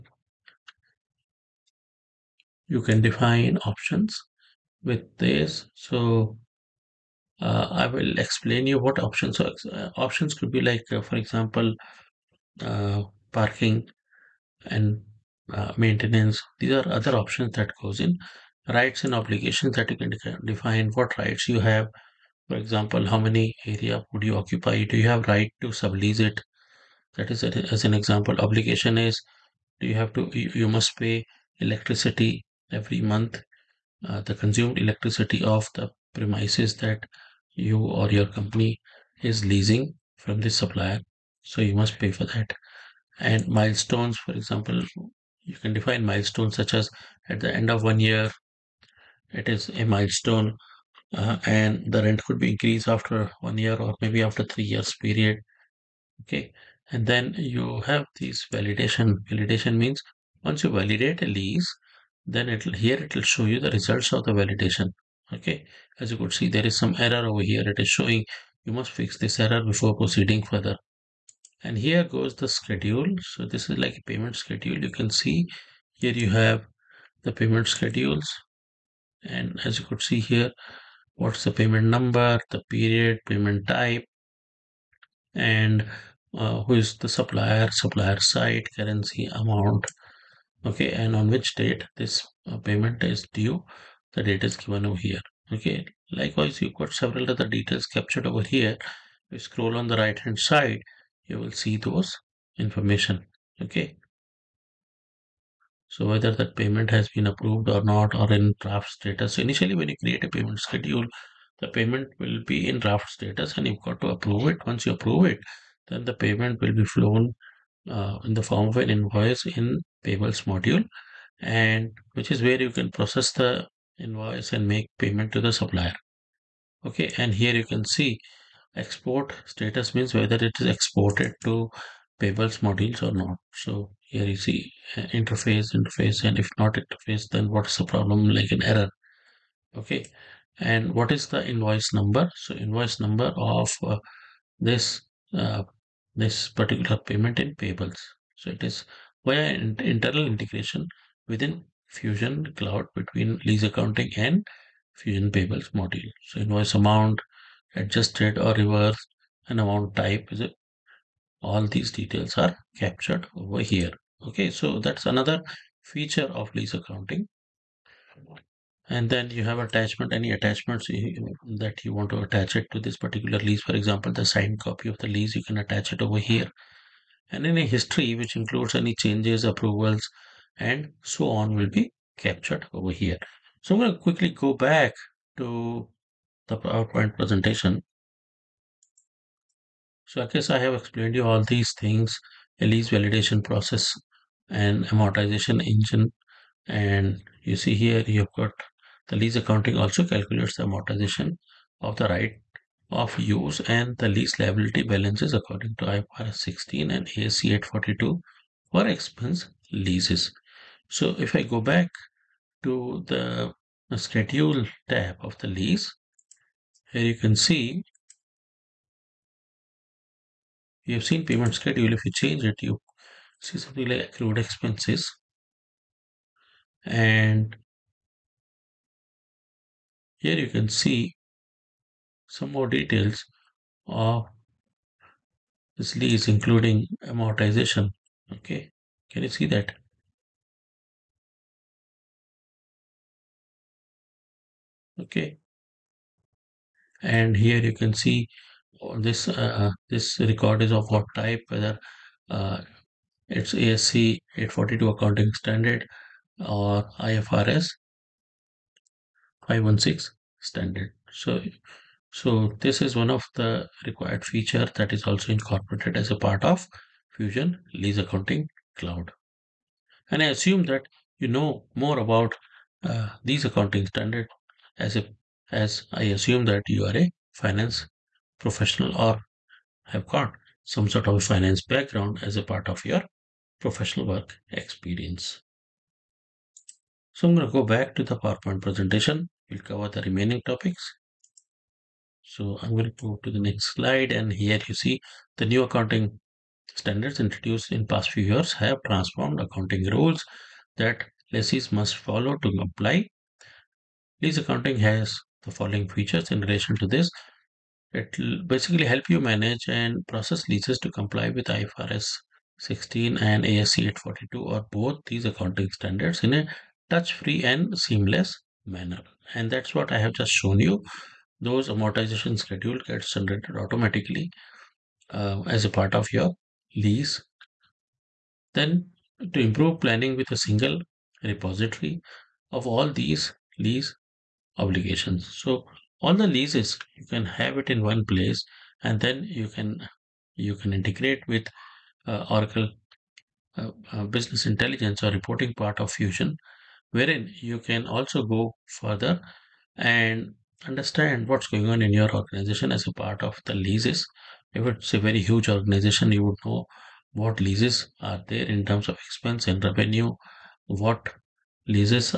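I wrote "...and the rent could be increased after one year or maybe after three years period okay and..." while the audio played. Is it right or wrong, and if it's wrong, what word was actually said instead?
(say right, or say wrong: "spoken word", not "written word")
right.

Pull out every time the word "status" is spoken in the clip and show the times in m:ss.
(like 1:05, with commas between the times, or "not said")
1:48, 1:53, 2:09.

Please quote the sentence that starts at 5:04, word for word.
Lease accounting has the following features in relation to this.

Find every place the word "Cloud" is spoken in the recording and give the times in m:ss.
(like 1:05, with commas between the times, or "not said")
2:32, 4:28.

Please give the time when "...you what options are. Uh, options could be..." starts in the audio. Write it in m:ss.
0:08.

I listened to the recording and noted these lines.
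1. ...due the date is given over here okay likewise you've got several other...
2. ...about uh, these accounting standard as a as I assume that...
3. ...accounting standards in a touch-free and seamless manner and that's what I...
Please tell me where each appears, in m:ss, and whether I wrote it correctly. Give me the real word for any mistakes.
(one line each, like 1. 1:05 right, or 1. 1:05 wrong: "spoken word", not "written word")
1. 1:33 right
2. 4:31 right
3. 5:15 right.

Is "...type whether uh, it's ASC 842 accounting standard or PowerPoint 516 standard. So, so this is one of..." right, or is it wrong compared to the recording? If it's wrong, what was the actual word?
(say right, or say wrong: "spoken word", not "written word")
wrong: "IFRS", not "PowerPoint".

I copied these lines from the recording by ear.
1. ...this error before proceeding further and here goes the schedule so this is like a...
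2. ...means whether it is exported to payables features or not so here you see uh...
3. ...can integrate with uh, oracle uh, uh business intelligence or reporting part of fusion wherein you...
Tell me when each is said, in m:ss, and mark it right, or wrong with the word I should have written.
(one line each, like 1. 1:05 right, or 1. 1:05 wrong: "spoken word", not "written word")
1. 1:09 right
2. 2:09 wrong: "modules", not "features"
3. 5:40 right.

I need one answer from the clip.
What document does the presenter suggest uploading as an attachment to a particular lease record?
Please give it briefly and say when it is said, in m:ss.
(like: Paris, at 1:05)
Signed copy of the lease, at 2:54.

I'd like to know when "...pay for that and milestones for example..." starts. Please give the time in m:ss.
0:41.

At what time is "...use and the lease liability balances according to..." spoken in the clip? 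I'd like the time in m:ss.
3:23.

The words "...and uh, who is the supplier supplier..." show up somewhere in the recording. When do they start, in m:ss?
1:25.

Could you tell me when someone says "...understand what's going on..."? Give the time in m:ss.
5:50.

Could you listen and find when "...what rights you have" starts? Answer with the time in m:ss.
0:20.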